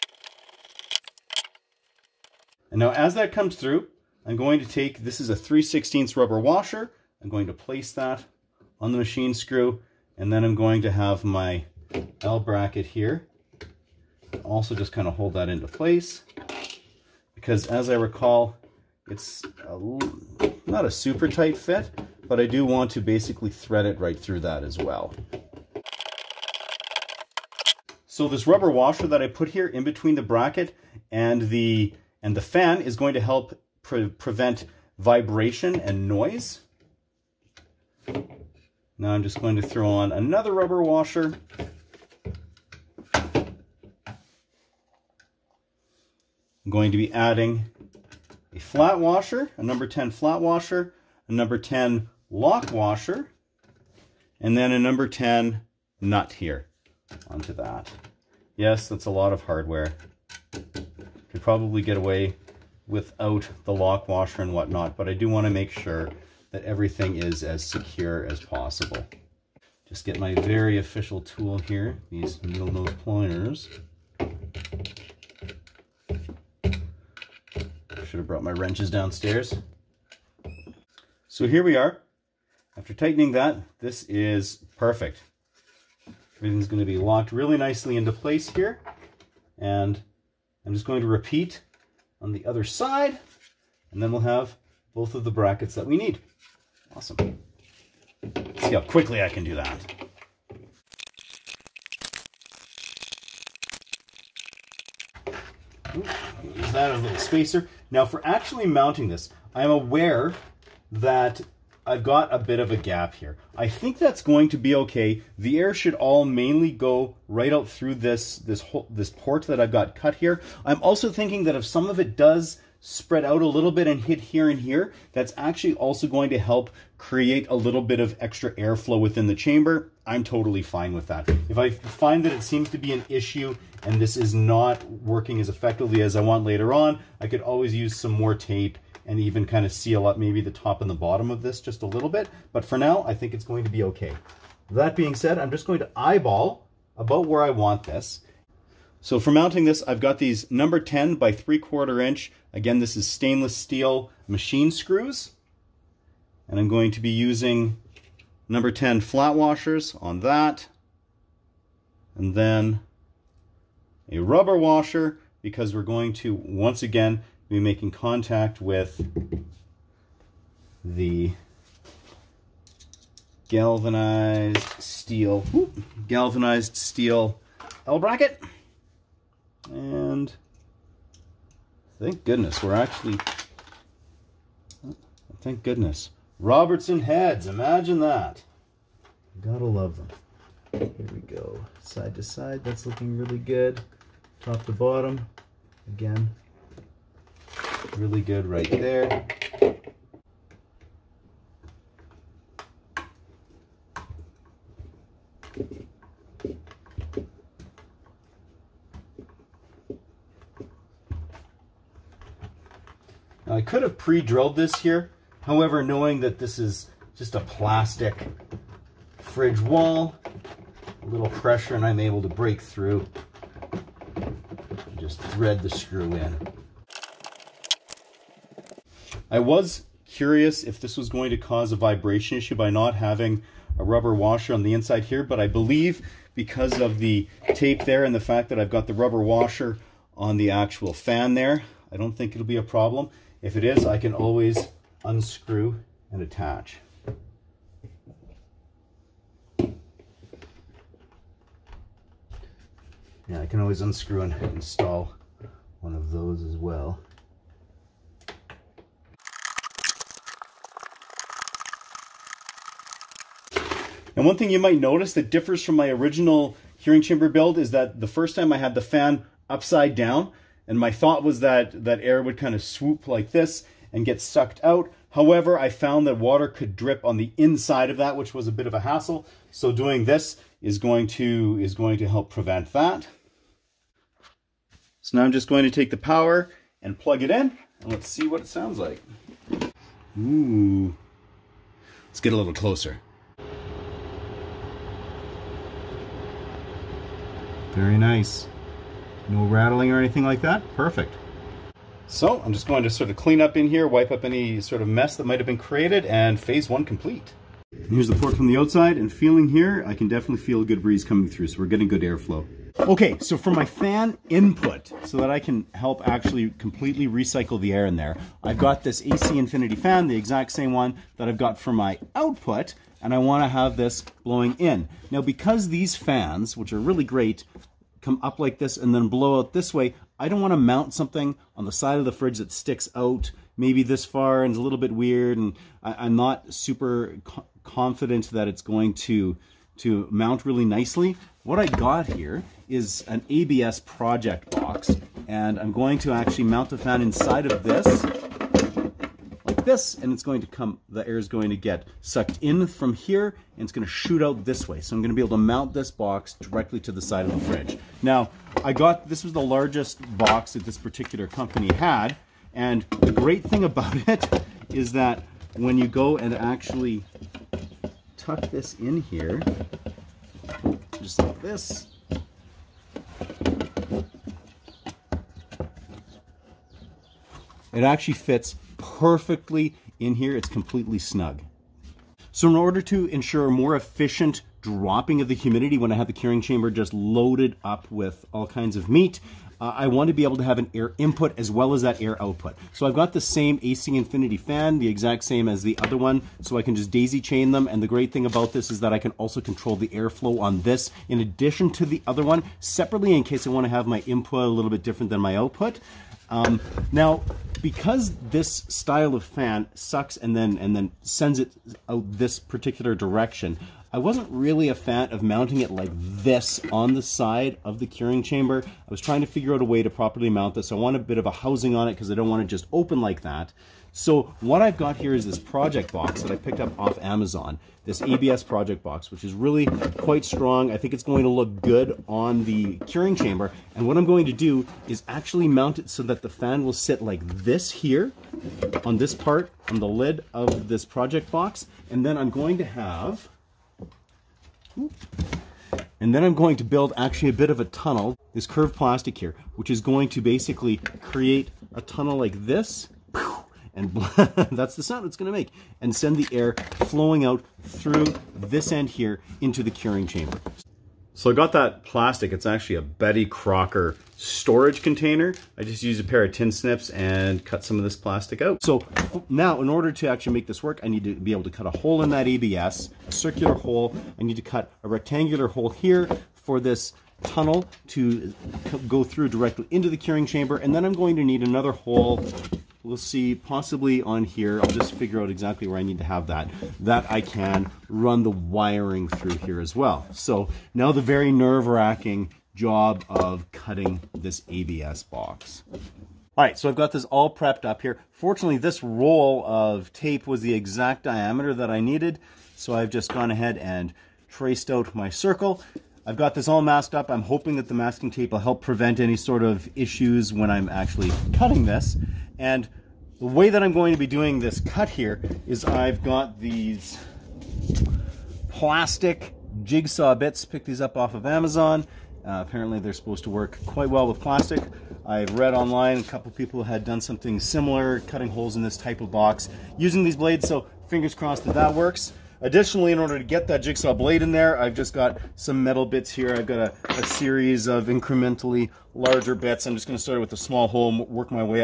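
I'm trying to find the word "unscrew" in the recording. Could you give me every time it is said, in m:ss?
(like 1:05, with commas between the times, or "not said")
4:05, 4:13.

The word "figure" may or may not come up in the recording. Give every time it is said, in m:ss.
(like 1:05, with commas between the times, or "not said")
6:59, 8:04.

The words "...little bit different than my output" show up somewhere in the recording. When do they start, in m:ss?
6:44.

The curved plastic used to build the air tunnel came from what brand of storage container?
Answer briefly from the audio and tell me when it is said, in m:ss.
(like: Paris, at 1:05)
Betty Crocker, at 7:42.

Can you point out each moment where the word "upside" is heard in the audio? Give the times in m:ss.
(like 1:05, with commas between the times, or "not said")
4:29.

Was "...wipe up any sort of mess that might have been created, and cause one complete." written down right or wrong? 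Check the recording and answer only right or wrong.
wrong.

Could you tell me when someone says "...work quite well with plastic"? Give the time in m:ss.
8:43.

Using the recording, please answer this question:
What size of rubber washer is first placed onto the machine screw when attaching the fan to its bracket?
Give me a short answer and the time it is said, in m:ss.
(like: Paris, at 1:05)
3/16, at 0:05.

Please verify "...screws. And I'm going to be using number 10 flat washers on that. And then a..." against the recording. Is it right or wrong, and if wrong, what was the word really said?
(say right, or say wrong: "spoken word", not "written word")
right.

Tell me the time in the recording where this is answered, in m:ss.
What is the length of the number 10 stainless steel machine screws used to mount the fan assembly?
2:31.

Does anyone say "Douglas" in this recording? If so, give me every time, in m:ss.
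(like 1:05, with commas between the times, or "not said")
not said.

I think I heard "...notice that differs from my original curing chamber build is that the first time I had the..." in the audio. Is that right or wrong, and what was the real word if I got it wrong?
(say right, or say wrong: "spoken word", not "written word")
right.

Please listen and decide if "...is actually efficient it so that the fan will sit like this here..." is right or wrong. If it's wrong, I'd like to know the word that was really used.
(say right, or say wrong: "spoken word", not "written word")
wrong: "mount", not "efficient".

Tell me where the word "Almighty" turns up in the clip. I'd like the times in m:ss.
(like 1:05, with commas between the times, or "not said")
not said.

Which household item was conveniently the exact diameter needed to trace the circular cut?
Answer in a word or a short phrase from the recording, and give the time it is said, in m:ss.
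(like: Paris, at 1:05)
roll of tape, at 8:18.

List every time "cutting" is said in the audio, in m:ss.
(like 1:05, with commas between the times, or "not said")
8:13, 8:31, 8:48.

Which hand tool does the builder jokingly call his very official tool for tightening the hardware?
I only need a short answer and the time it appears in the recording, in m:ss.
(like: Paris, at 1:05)
needle nose pliers, at 1:12.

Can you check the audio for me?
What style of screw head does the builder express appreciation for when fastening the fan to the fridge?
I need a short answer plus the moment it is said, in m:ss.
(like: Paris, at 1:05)
Robertson, at 3:06.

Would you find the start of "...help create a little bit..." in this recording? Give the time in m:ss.
2:06.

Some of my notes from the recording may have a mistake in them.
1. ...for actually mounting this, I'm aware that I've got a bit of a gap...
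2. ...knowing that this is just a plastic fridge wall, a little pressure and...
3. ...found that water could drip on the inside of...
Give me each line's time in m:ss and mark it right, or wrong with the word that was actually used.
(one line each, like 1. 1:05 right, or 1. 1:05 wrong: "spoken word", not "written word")
1. 1:48 right
2. 3:35 right
3. 4:35 right.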